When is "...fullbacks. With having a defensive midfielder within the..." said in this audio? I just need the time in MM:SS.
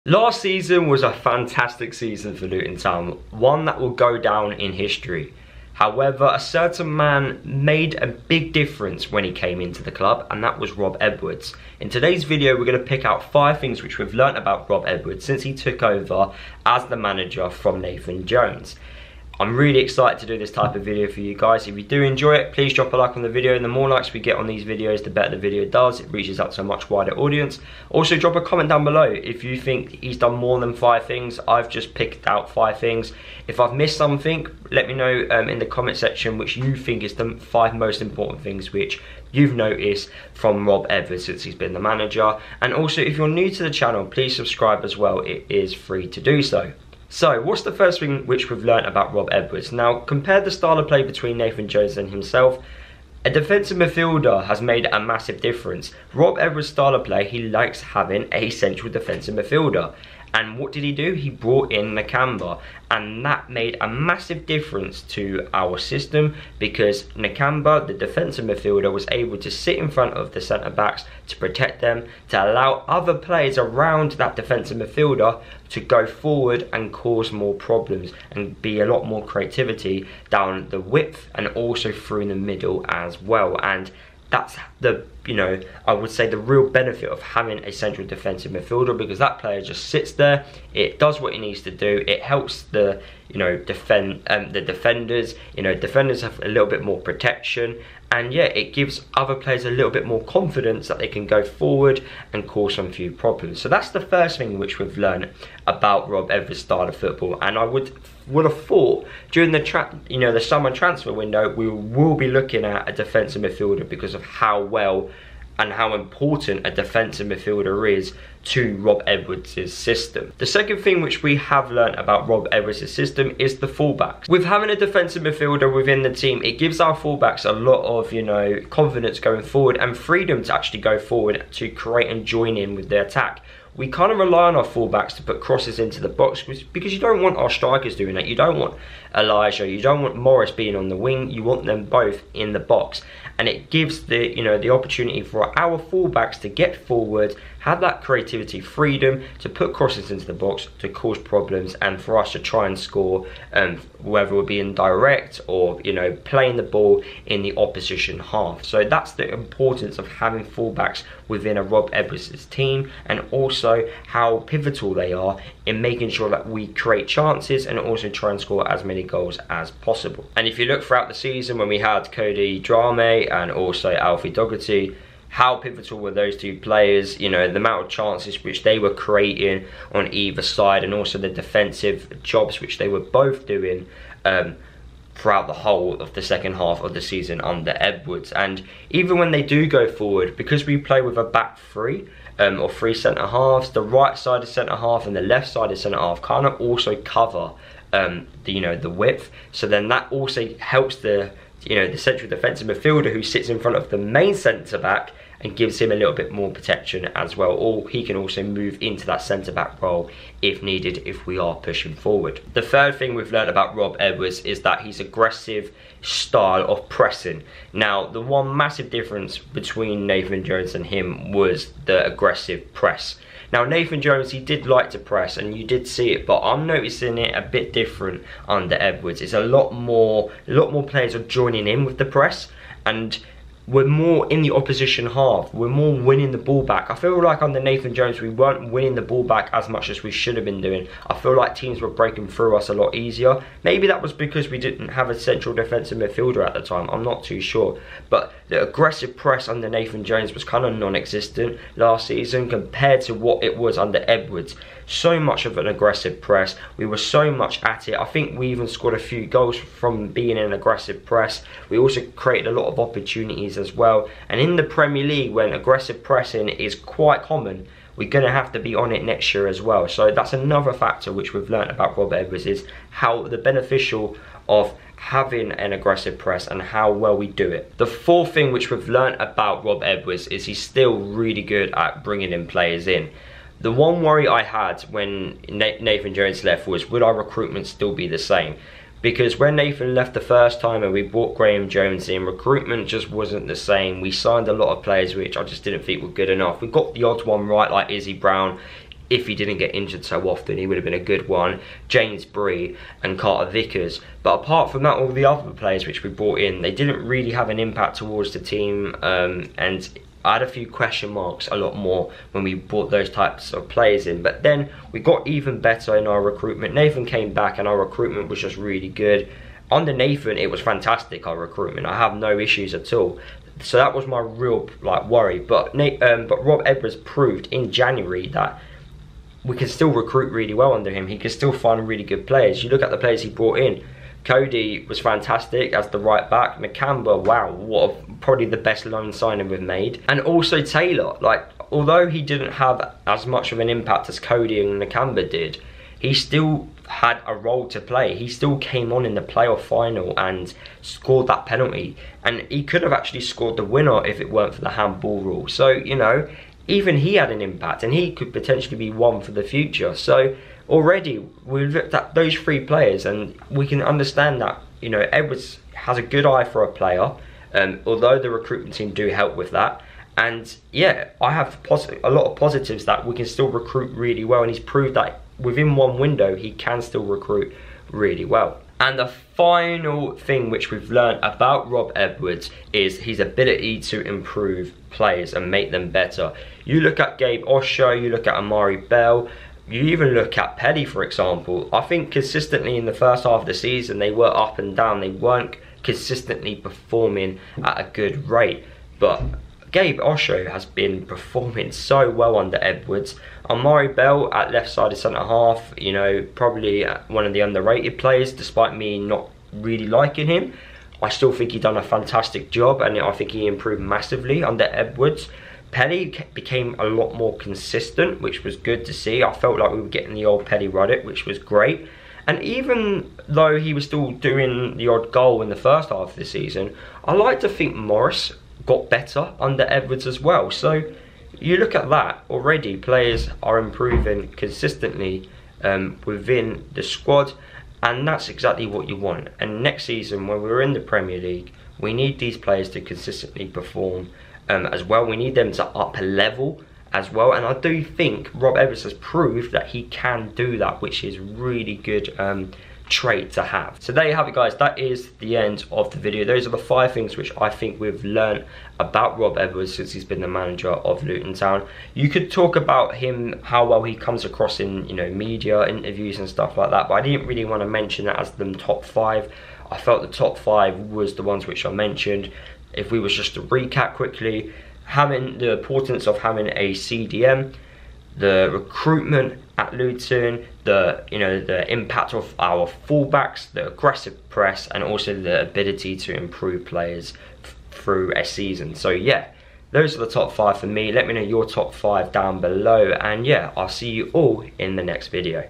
02:03.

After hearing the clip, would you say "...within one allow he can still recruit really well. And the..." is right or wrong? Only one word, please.
wrong.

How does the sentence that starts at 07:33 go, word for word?
So there you have it guys, that is the end of the video.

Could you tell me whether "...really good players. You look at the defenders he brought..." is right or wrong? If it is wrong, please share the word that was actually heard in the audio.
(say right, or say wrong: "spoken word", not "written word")
wrong: "players", not "defenders".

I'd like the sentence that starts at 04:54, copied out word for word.
We signed a lot of players which I just didn't think were good enough.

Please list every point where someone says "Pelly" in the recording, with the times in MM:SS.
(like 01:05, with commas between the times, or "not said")
06:30, 06:55, 07:00.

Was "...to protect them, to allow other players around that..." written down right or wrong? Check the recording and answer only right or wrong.
right.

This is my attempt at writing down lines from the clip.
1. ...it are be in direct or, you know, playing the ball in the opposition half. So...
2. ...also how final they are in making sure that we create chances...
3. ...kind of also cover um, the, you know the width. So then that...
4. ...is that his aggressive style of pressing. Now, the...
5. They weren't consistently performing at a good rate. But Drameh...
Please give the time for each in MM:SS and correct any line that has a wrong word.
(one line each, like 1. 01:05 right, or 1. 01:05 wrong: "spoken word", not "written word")
1. 02:34 right
2. 02:43 wrong: "pivotal", not "final"
3. 03:16 right
4. 03:34 right
5. 06:34 wrong: "Gabe", not "Drameh".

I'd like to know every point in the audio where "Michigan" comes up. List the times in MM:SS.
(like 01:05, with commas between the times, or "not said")
not said.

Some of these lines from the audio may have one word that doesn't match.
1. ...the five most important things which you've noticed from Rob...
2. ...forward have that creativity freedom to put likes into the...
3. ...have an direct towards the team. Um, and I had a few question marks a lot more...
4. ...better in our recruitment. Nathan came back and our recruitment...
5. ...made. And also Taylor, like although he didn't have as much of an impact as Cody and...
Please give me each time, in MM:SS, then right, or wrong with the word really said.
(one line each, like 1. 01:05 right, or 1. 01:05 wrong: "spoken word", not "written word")
1. 00:37 right
2. 02:26 wrong: "crosses", not "likes"
3. 05:07 wrong: "impact", not "direct"
4. 05:15 right
5. 05:39 right.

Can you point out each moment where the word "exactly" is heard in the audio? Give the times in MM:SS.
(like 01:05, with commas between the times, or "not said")
07:18.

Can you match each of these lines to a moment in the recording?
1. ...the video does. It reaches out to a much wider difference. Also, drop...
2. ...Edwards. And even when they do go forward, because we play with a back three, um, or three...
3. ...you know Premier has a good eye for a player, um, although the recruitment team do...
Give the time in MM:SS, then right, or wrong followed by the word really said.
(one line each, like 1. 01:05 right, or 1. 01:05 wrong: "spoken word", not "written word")
1. 00:25 wrong: "audience", not "difference"
2. 03:07 right
3. 06:04 wrong: "Edwards", not "Premier".